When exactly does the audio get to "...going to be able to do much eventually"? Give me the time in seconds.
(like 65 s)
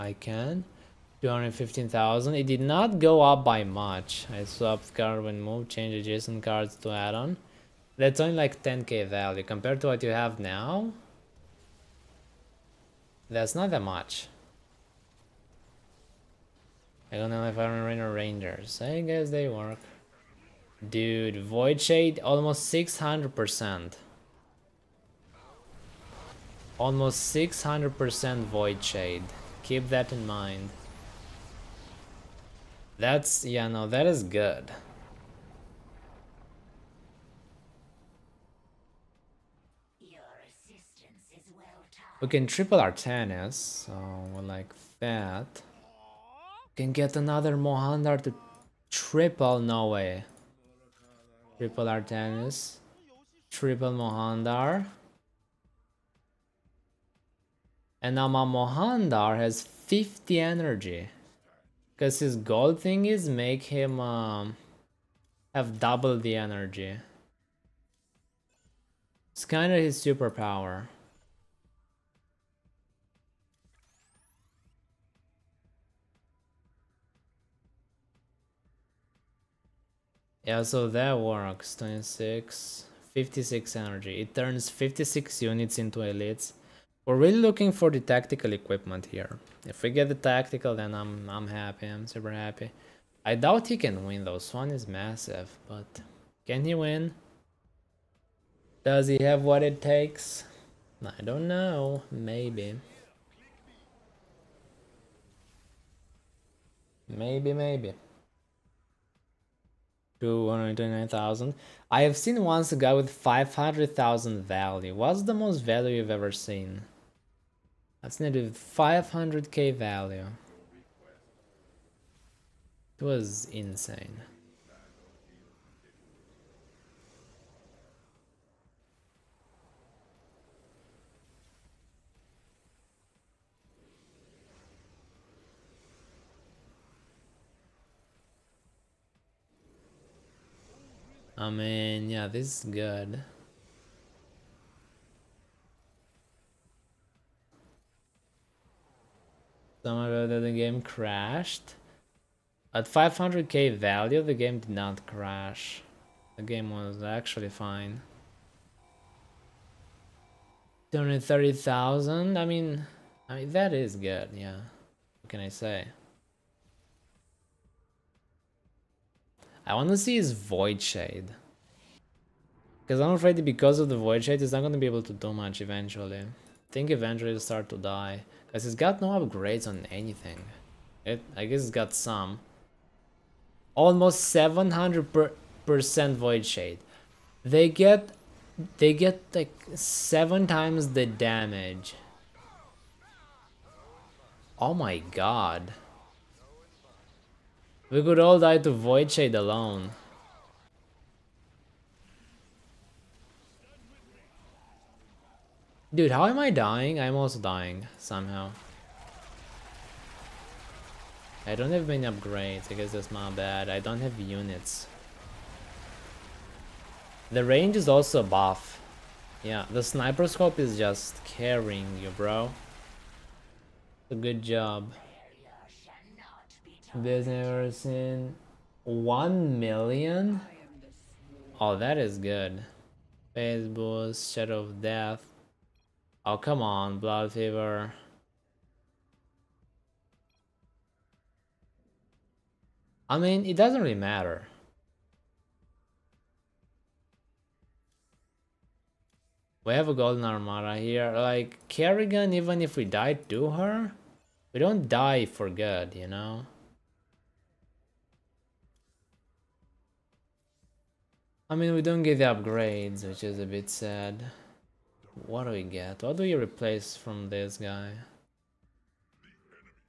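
174 s.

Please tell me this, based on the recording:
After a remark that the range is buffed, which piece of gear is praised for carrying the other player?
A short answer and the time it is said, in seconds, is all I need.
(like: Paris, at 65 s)
Sniper scope, at 219 s.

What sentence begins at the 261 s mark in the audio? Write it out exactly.
I mean, we don't get the upgrades, which is a bit sad.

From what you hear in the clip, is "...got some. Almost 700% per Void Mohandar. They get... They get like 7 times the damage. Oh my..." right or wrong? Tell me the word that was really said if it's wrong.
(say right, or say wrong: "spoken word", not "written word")
wrong: "Shade", not "Mohandar".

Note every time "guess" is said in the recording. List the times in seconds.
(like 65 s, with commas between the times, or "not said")
18 s, 181 s, 212 s.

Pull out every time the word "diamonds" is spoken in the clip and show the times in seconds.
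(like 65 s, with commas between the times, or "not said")
not said.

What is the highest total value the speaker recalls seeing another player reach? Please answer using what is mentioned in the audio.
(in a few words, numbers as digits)
500,000.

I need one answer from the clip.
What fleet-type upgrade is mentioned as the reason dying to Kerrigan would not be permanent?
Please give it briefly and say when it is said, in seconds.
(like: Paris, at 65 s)
Golden Armada, at 249 s.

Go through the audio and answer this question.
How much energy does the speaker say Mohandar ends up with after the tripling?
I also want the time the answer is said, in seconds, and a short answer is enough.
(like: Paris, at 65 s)
56, at 83 s.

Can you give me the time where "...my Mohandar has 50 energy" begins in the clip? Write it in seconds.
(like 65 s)
58 s.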